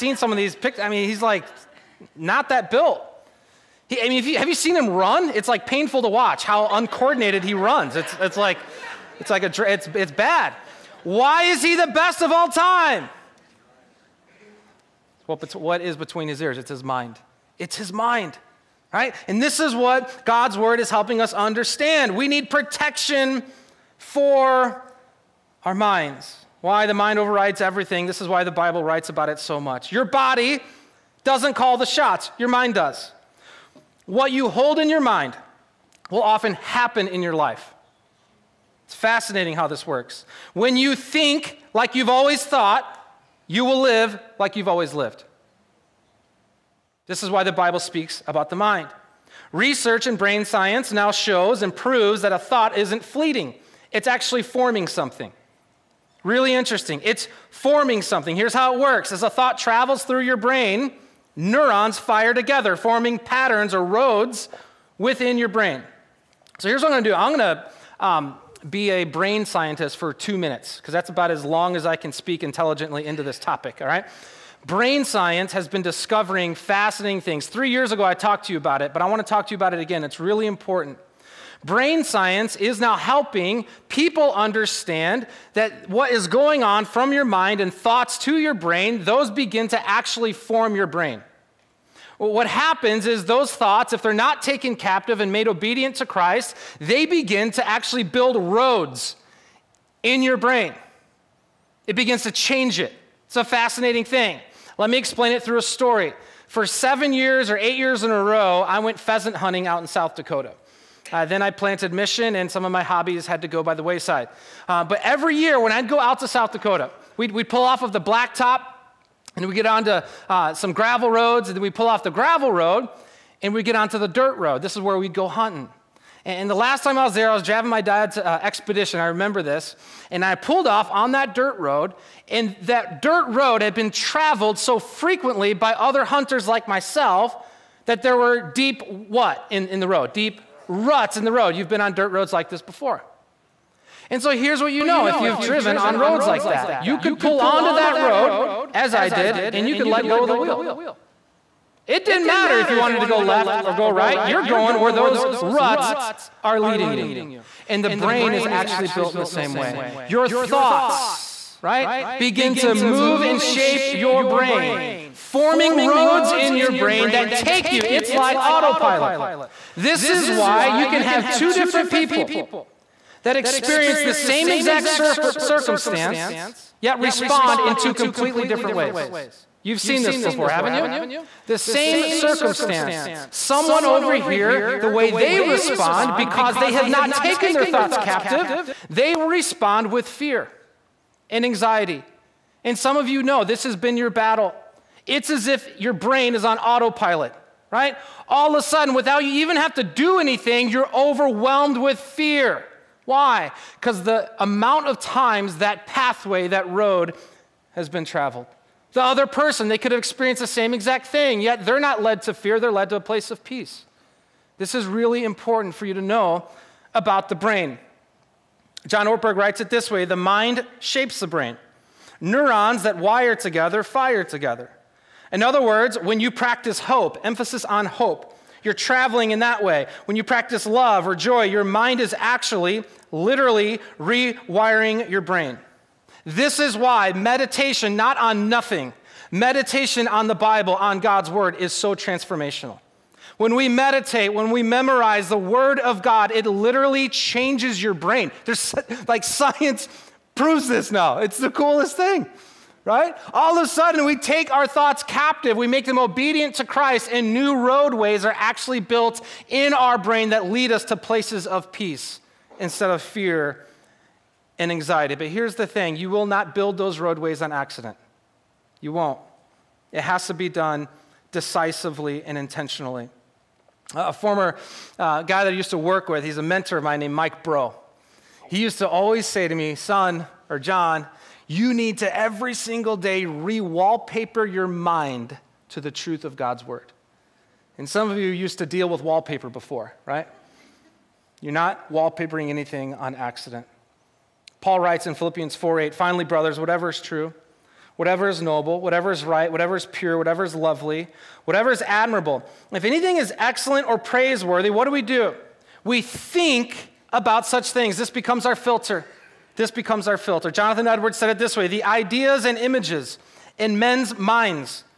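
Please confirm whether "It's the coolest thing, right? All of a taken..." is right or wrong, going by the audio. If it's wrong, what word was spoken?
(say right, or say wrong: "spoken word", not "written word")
wrong: "sudden", not "taken".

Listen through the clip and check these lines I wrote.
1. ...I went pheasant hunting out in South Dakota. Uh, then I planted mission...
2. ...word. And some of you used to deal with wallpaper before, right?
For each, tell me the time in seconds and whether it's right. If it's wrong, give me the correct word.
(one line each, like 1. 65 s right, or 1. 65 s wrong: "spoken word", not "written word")
1. 108 s right
2. 286 s right.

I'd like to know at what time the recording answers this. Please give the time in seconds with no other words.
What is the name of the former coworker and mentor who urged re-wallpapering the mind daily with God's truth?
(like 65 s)
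277 s.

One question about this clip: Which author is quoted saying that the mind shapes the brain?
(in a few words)
John Ortberg.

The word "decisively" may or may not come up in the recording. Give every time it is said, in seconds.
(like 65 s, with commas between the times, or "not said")
271 s.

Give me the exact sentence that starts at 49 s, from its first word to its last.
Research in brain science now shows and proves that a thought isn't fleeting, it's actually forming something.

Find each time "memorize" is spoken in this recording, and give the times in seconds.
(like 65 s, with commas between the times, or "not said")
244 s.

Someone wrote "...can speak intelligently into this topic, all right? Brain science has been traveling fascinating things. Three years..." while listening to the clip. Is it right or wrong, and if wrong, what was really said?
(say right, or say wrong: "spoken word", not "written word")
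wrong: "discovering", not "traveling".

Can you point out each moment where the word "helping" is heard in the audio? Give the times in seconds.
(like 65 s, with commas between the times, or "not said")
20 s, 82 s.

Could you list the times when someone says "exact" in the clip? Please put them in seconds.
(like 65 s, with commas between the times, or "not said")
174 s, 210 s.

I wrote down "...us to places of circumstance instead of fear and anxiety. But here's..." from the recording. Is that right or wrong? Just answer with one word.
wrong.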